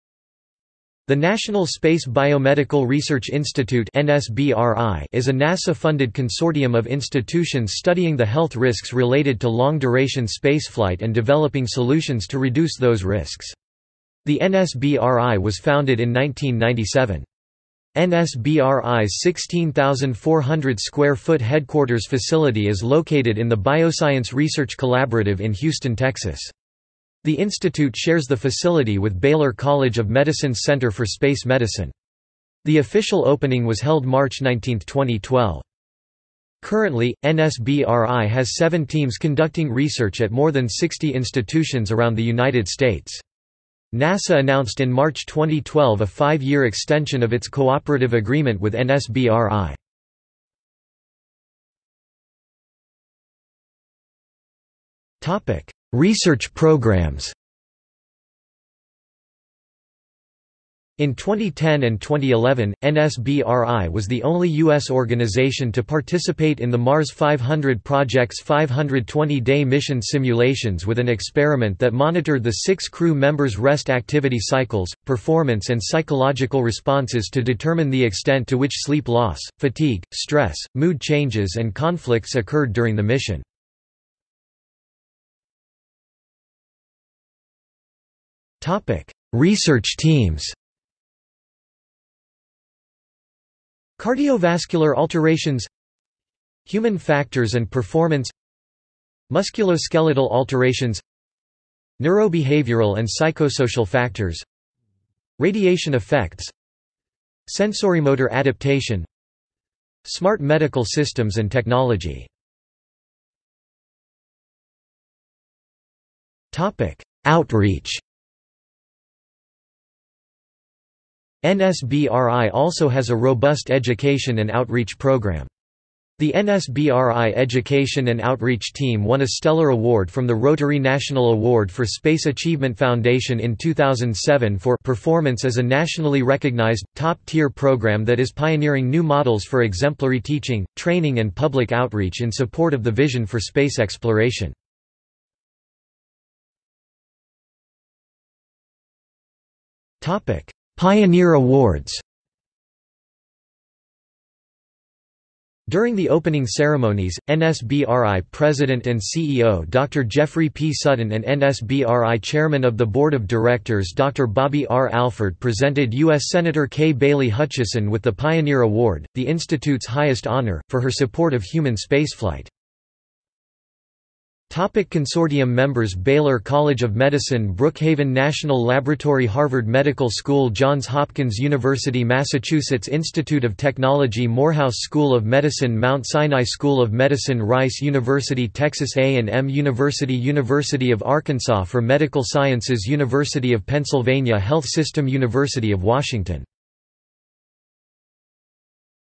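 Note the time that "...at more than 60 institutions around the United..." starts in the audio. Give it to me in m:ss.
0:40.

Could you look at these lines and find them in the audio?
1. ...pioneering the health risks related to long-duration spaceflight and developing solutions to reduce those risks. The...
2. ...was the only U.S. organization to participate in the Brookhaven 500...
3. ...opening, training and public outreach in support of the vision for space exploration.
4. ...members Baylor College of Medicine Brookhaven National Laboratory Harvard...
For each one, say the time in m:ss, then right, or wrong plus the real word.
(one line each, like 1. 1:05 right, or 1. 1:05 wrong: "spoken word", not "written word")
1. 0:07 wrong: "studying", not "pioneering"
2. 1:03 wrong: "Mars", not "Brookhaven"
3. 2:20 wrong: "teaching", not "opening"
4. 2:55 right.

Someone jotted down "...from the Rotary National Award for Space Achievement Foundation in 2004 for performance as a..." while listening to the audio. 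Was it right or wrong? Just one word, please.
wrong.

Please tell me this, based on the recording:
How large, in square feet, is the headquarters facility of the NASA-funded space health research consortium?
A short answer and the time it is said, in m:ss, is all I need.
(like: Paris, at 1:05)
16,400 square feet, at 0:19.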